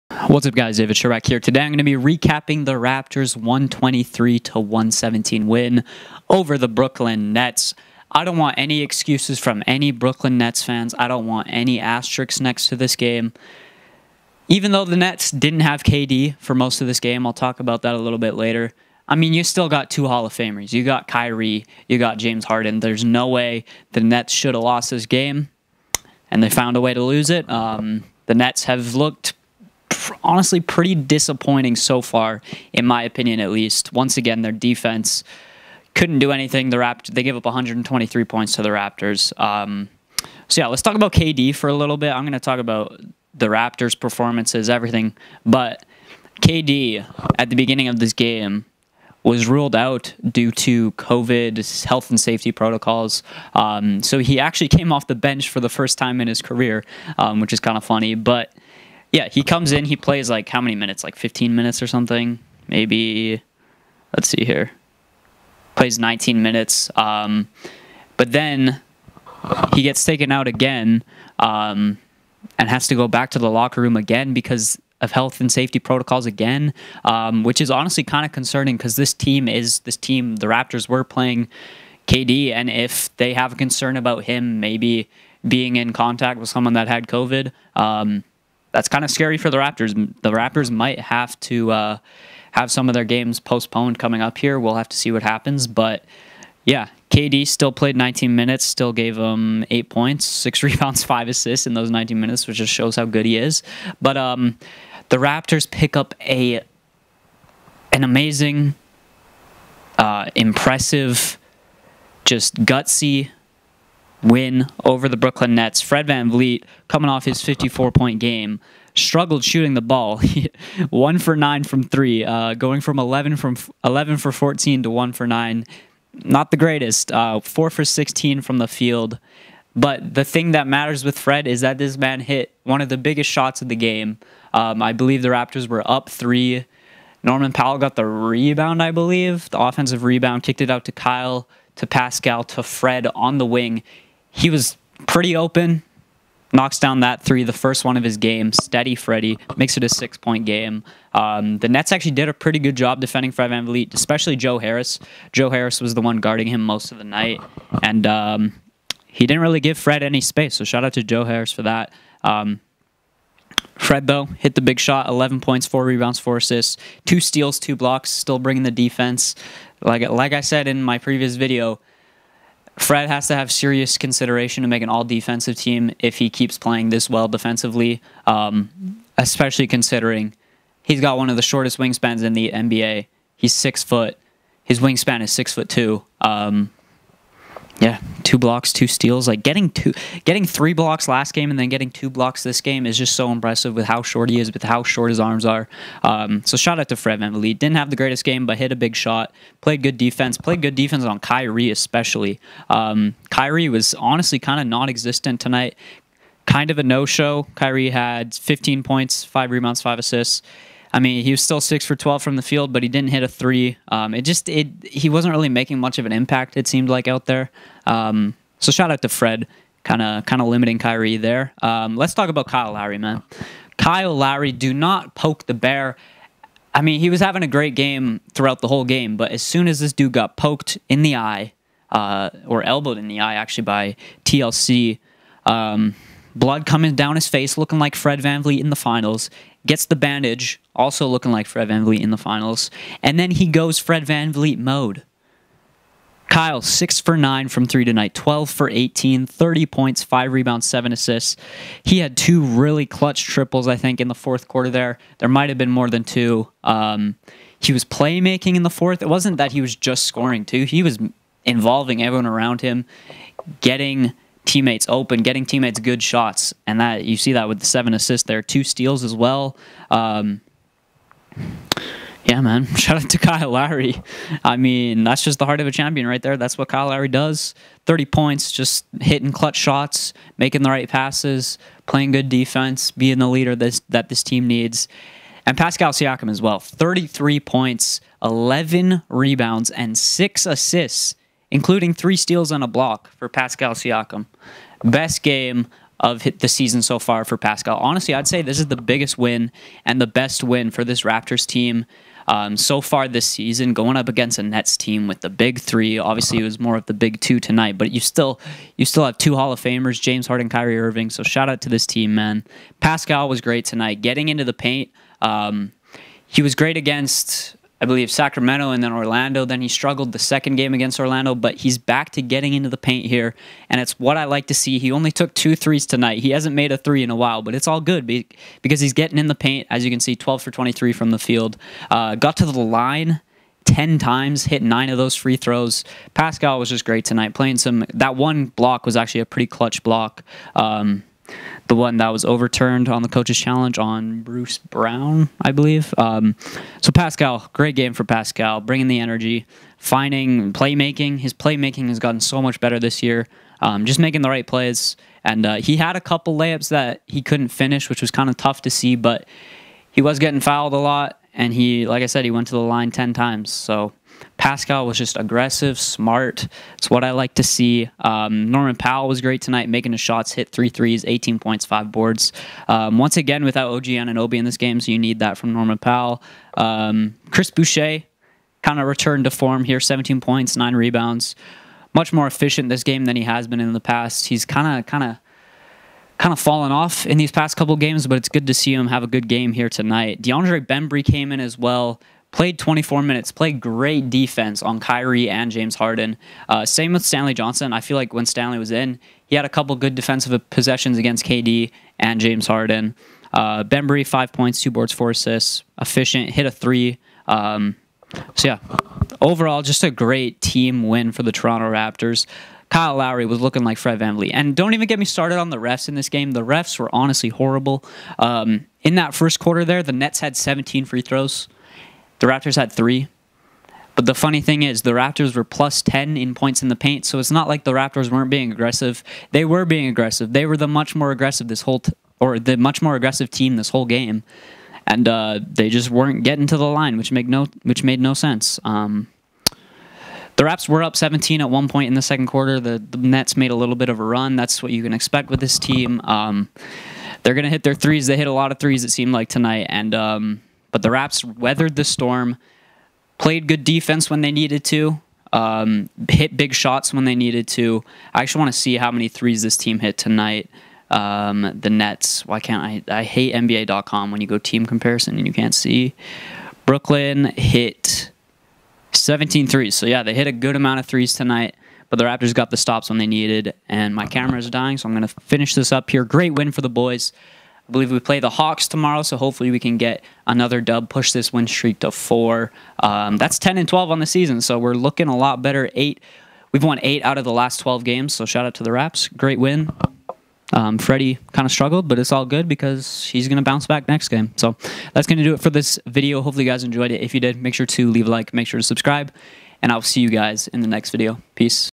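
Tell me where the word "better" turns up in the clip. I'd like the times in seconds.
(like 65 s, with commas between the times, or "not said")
352 s, 485 s.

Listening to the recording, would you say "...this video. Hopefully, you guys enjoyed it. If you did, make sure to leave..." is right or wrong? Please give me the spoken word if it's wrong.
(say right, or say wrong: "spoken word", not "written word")
right.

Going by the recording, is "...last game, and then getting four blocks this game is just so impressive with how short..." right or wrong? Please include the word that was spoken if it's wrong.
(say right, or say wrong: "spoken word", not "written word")
wrong: "two", not "four".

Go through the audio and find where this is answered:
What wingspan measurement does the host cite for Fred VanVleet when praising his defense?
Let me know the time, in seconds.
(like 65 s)
185 s.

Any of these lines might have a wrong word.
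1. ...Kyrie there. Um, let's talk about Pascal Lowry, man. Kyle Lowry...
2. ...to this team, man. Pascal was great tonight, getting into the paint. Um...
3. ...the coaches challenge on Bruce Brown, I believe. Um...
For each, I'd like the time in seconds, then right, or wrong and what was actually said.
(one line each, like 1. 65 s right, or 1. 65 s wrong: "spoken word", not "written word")
1. 220 s wrong: "Kyle", not "Pascal"
2. 311 s right
3. 343 s right.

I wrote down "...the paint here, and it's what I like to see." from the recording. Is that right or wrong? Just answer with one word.
right.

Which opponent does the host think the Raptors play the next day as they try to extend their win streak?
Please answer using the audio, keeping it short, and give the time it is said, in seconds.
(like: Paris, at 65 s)
Hawks, at 478 s.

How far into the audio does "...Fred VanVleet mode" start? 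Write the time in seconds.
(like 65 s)
243 s.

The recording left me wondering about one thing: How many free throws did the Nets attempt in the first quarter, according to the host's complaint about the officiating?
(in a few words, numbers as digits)
17.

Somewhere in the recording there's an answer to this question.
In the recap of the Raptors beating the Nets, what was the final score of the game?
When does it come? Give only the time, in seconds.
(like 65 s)
3 s.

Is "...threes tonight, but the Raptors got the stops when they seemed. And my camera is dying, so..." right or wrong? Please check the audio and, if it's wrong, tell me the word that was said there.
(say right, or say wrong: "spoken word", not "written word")
wrong: "needed", not "seemed".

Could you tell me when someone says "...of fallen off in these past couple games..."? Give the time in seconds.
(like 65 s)
386 s.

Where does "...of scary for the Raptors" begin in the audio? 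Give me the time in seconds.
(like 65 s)
89 s.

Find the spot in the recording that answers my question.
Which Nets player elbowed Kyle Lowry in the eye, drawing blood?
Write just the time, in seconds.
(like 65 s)
234 s.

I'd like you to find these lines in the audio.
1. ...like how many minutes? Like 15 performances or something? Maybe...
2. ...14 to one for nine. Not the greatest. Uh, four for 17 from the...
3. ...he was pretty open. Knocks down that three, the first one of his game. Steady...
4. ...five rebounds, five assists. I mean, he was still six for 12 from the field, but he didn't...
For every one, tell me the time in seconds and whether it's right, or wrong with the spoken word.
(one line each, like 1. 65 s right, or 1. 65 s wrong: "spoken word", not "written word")
1. 60 s wrong: "minutes", not "performances"
2. 124 s wrong: "16", not "17"
3. 144 s right
4. 209 s right.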